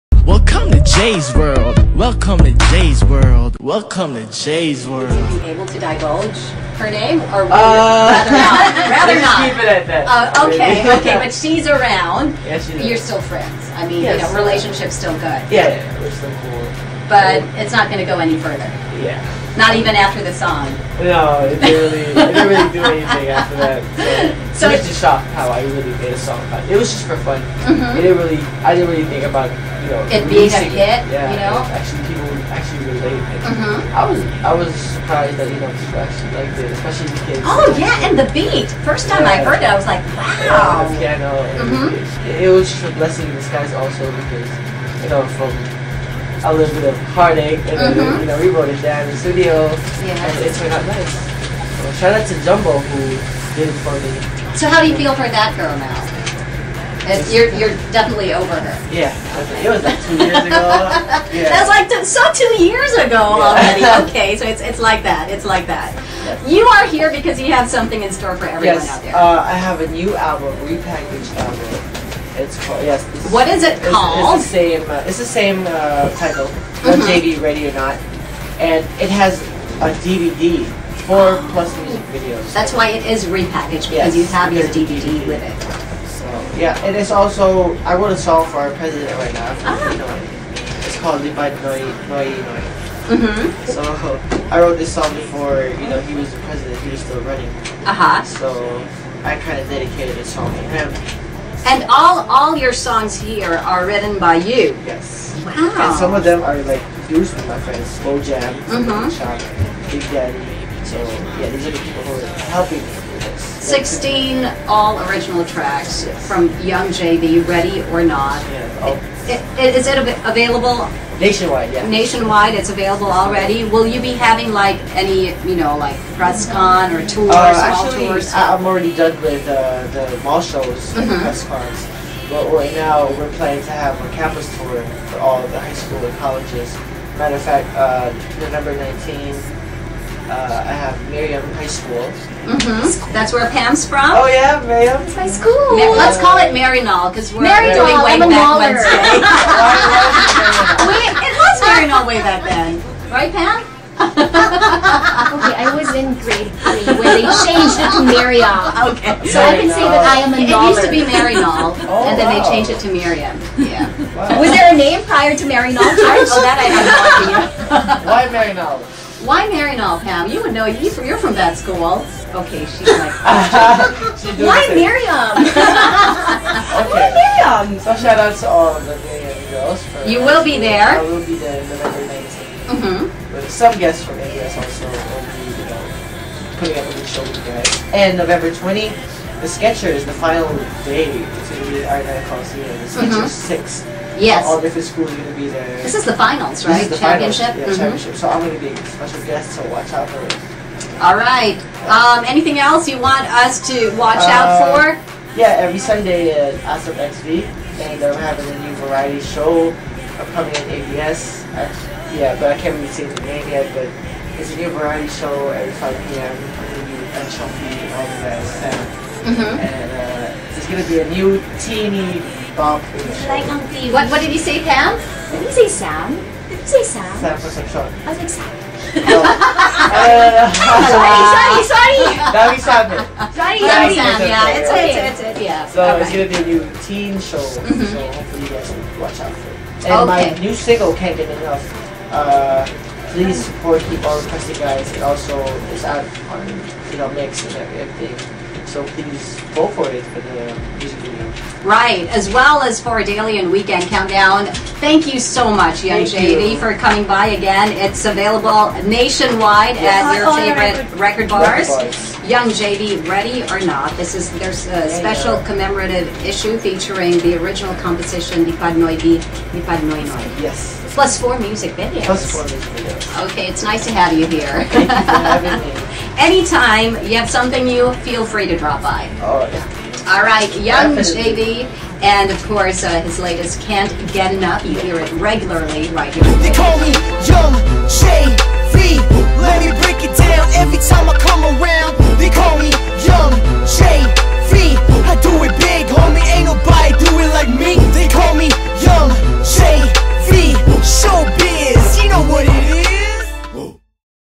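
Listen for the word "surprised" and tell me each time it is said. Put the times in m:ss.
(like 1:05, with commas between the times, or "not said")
0:34.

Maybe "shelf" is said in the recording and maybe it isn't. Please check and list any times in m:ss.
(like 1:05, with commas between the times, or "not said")
not said.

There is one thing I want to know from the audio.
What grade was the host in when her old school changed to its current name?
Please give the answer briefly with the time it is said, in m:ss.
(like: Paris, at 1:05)
Grade 3, at 2:36.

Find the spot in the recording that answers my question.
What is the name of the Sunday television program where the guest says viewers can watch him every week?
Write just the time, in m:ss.
3:26.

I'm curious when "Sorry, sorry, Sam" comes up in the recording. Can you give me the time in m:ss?
3:53.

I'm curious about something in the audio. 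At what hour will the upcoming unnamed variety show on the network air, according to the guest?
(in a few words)
5 p.m.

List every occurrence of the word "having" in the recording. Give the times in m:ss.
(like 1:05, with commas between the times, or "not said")
2:04, 3:28.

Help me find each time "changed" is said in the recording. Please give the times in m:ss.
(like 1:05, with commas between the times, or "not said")
2:37, 2:42.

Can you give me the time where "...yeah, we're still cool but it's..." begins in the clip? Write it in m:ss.
0:15.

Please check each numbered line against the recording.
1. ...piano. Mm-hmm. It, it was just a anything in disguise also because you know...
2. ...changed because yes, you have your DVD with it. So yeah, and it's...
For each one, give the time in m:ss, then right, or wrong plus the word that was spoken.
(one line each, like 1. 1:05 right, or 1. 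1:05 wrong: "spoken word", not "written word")
1. 0:40 wrong: "blessing", not "anything"
2. 1:23 wrong: "repackaged", not "changed".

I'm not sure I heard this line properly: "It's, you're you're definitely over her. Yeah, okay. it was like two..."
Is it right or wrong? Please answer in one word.
right.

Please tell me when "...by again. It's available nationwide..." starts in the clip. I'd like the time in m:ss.
4:17.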